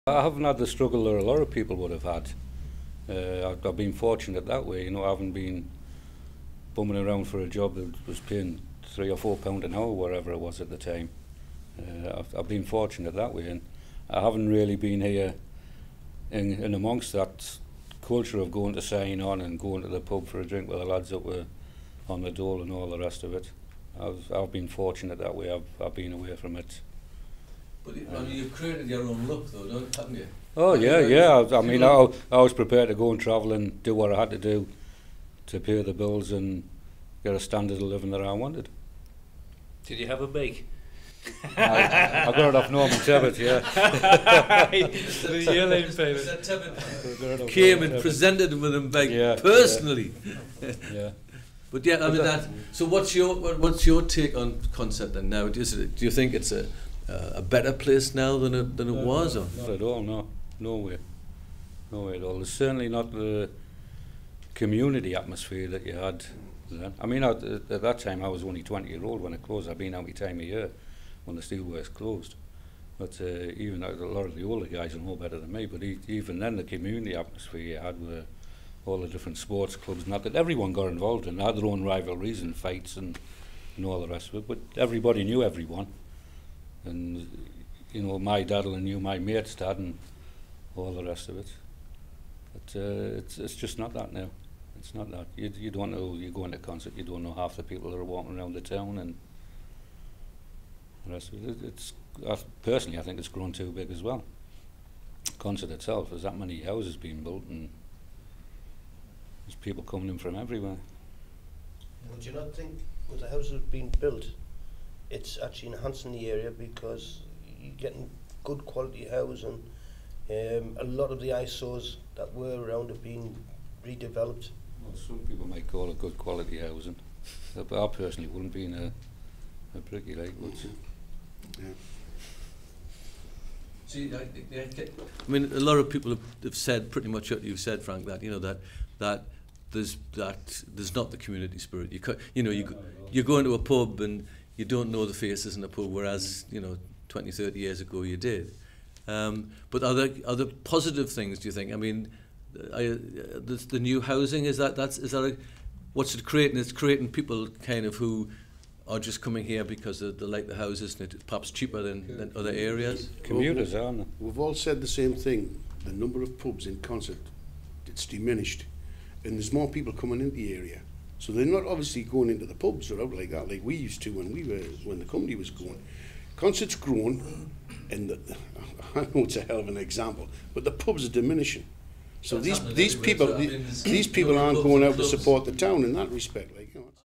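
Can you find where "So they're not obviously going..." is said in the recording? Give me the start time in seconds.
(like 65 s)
171 s.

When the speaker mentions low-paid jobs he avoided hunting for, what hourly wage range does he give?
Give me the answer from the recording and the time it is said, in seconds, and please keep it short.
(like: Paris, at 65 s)
3 or 4 pounds an hour, at 8 s.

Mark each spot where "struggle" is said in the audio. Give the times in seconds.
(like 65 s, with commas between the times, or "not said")
0 s.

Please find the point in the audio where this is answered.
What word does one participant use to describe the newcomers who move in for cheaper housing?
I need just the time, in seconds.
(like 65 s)
163 s.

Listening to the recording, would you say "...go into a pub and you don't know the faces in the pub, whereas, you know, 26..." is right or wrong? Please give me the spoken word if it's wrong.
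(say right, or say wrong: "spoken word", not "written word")
wrong: "20", not "26".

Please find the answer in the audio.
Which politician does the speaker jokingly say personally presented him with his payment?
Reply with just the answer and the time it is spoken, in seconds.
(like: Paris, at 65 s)
Norman Tebbit, at 42 s.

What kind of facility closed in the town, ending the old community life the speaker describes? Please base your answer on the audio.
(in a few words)
the steelworks.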